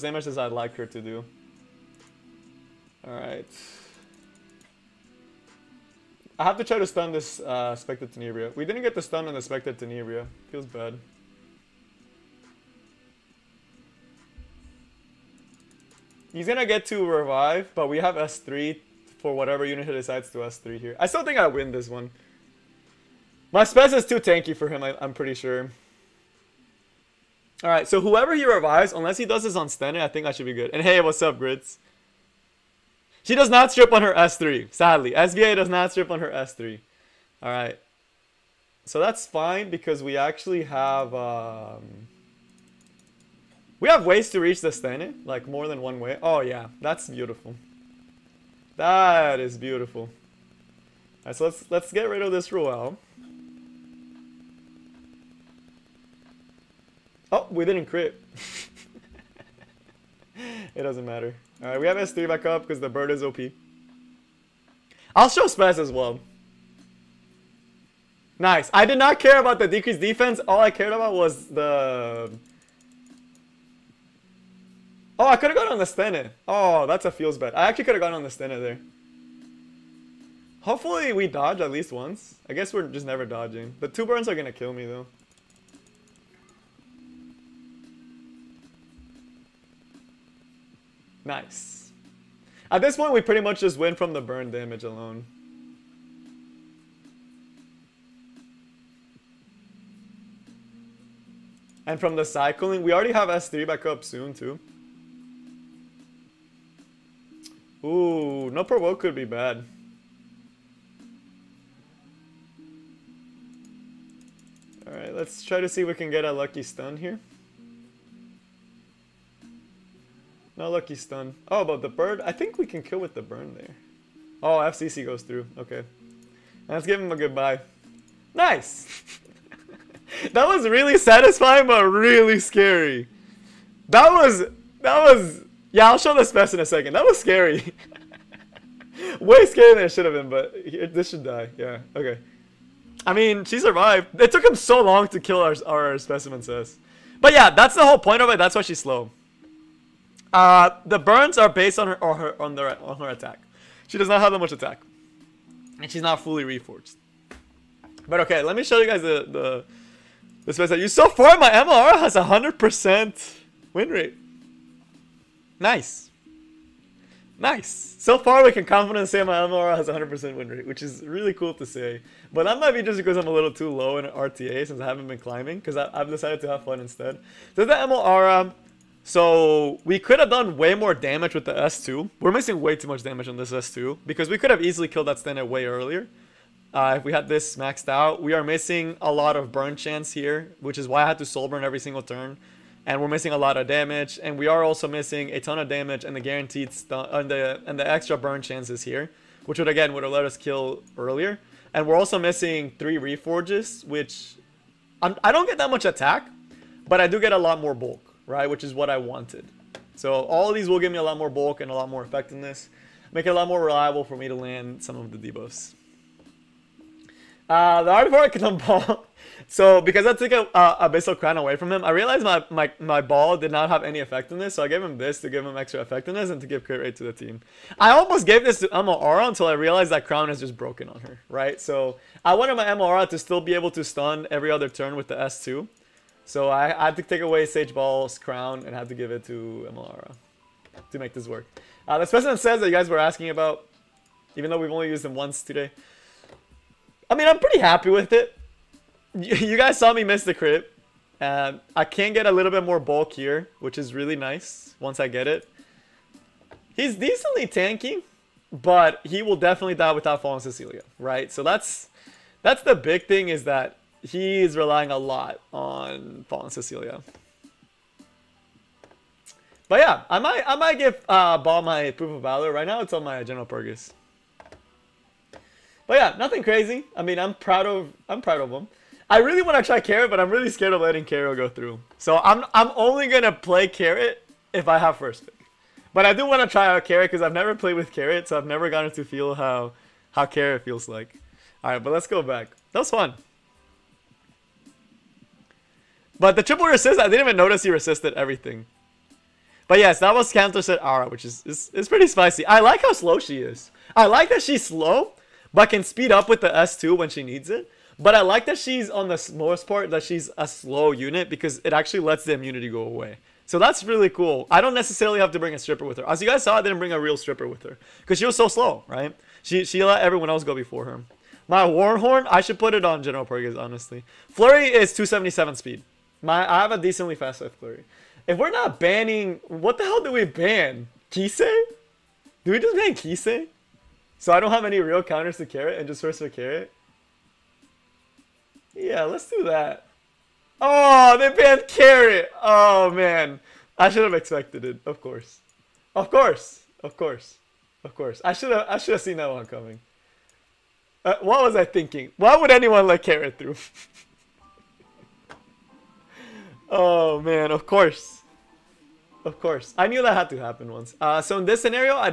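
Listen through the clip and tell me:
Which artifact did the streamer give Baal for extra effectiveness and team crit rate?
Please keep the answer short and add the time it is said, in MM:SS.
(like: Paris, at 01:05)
Art of Arcanum, at 03:37.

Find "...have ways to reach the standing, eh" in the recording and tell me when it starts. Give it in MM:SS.
00:43.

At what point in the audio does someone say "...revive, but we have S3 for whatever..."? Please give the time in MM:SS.
00:17.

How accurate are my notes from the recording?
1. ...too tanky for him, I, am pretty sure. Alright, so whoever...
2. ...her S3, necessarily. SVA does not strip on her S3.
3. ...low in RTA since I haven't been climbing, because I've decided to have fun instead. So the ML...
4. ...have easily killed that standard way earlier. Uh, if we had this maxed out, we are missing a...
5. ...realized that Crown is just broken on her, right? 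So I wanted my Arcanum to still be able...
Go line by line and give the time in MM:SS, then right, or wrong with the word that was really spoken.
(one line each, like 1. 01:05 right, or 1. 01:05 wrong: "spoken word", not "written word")
1. 00:24 right
2. 00:34 wrong: "sadly", not "necessarily"
3. 02:53 right
4. 03:04 right
5. 03:49 wrong: "MOR", not "Arcanum".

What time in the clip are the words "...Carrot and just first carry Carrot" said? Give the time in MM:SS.
05:35.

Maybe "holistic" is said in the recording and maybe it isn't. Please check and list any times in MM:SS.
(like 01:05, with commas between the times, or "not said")
not said.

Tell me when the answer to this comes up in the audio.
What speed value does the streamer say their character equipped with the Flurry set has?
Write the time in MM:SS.
05:24.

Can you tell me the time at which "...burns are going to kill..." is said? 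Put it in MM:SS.
01:24.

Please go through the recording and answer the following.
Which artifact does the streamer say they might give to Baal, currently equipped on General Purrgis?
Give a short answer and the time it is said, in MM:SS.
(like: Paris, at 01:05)
Proof of Valor, at 04:31.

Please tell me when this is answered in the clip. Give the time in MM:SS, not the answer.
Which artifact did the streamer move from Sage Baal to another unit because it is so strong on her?
03:40.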